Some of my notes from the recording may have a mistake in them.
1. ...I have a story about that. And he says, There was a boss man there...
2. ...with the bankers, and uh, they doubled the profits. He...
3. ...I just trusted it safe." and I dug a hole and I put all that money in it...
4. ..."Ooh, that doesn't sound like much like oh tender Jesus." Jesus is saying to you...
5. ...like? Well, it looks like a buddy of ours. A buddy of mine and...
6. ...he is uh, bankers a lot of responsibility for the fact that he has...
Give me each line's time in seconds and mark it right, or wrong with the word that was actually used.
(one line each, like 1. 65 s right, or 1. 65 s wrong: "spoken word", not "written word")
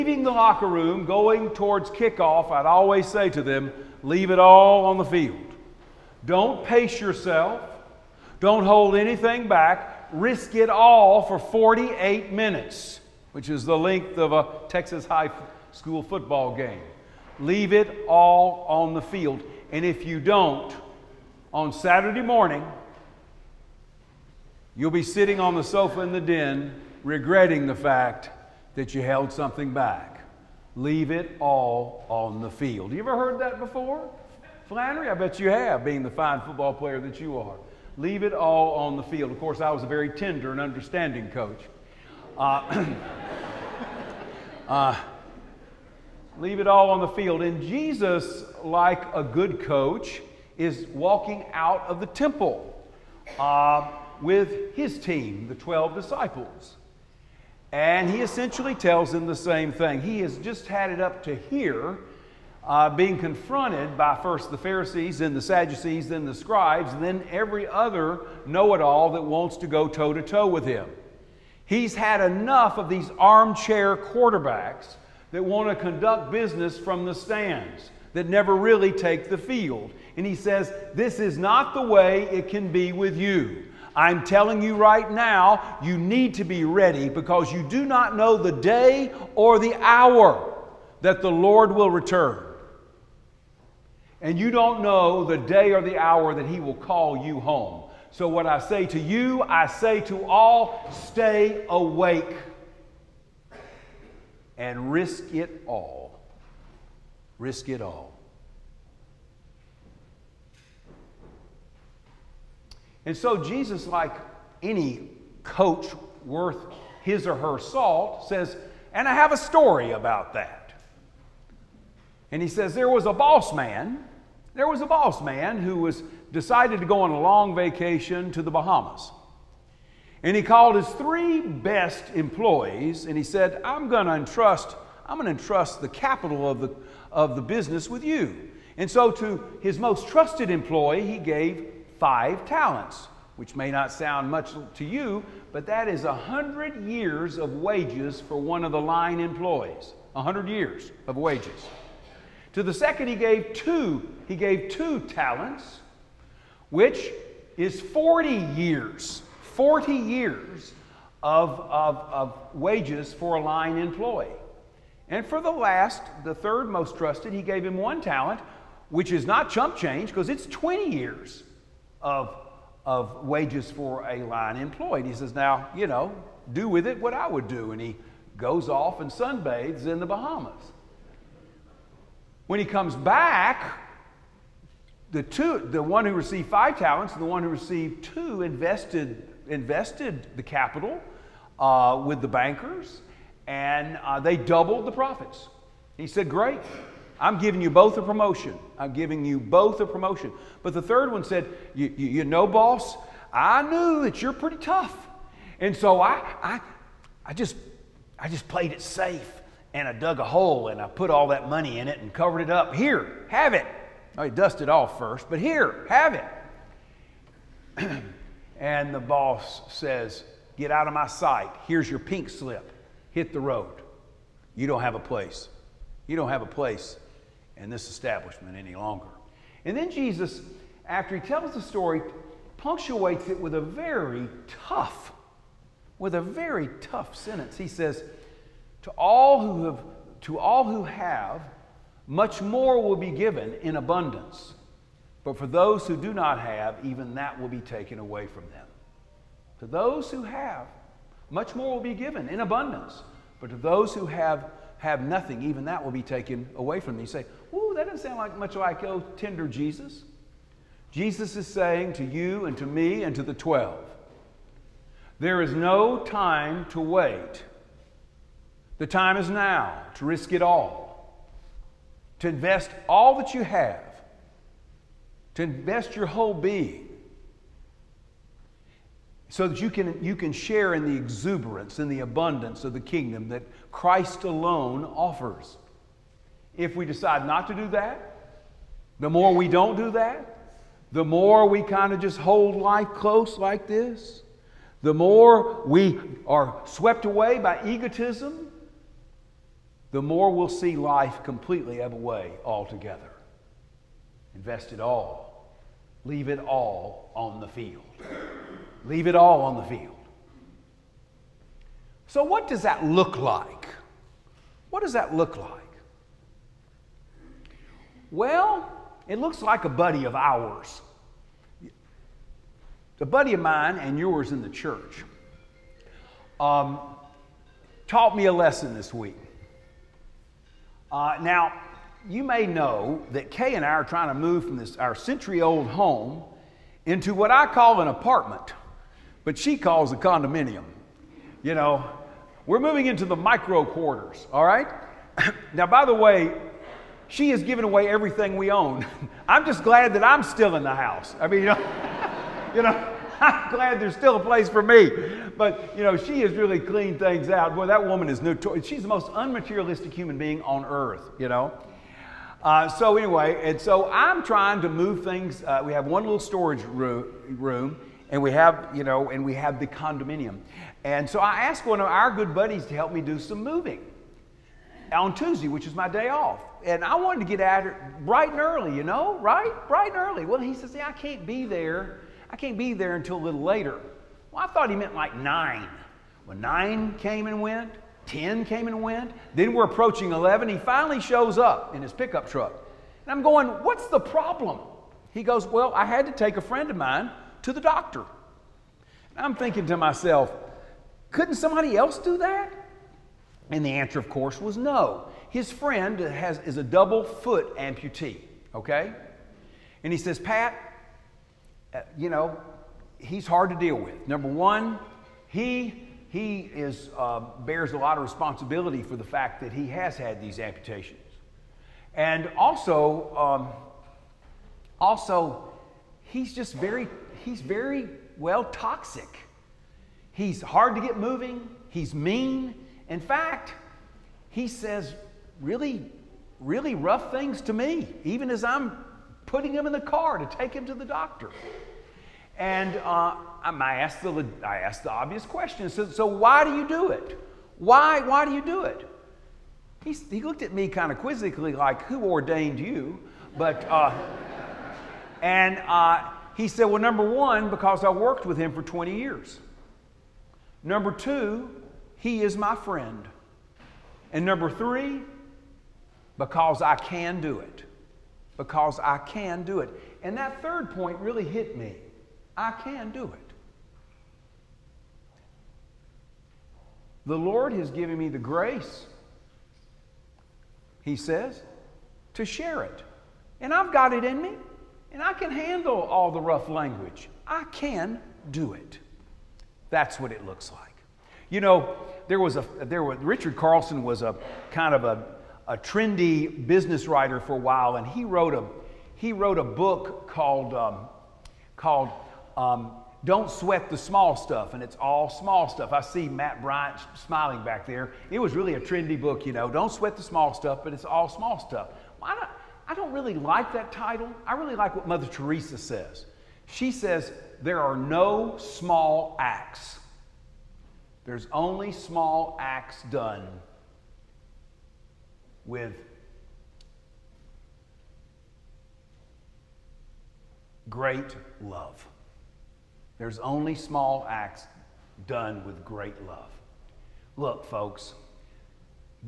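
1. 119 s right
2. 192 s right
3. 208 s wrong: "played", not "trusted"
4. 257 s right
5. 315 s right
6. 416 s wrong: "bears", not "bankers".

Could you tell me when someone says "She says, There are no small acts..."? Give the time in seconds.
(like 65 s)
516 s.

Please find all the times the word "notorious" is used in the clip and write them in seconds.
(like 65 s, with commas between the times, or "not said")
358 s.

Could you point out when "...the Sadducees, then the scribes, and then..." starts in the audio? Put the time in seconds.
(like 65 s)
65 s.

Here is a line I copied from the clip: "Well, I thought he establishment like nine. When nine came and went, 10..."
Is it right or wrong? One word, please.
wrong.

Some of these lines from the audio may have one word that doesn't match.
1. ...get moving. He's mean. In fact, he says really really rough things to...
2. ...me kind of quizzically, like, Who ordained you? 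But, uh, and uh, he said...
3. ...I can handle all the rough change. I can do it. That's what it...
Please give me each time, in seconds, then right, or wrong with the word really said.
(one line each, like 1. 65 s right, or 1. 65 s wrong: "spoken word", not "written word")
1. 430 s right
2. 450 s right
3. 485 s wrong: "language", not "change".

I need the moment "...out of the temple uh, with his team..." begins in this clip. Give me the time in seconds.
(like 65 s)
51 s.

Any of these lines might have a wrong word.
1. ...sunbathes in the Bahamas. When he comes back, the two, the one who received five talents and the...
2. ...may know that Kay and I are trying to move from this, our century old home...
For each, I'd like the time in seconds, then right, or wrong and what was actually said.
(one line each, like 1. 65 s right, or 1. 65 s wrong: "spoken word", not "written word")
1. 179 s right
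2. 332 s right.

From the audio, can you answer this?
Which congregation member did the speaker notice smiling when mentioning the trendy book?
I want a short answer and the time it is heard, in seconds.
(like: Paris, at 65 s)
Matt Bryant, at 506 s.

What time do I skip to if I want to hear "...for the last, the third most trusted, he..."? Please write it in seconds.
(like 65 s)
165 s.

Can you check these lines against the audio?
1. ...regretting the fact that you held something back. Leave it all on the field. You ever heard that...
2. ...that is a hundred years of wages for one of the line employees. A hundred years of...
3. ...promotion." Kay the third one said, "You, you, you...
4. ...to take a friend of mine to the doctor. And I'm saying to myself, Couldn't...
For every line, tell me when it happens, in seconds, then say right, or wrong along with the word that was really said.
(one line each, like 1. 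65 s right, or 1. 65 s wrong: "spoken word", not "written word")
1. 27 s right
2. 145 s right
3. 199 s wrong: "But", not "Kay"
4. 396 s wrong: "thinking", not "saying".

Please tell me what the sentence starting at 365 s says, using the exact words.
Uh, we have one little storage room, room, and we have, you know, and we have the condominium.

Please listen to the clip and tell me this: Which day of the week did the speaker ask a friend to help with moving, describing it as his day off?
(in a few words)
Tuesday.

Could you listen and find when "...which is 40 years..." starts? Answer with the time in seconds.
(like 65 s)
156 s.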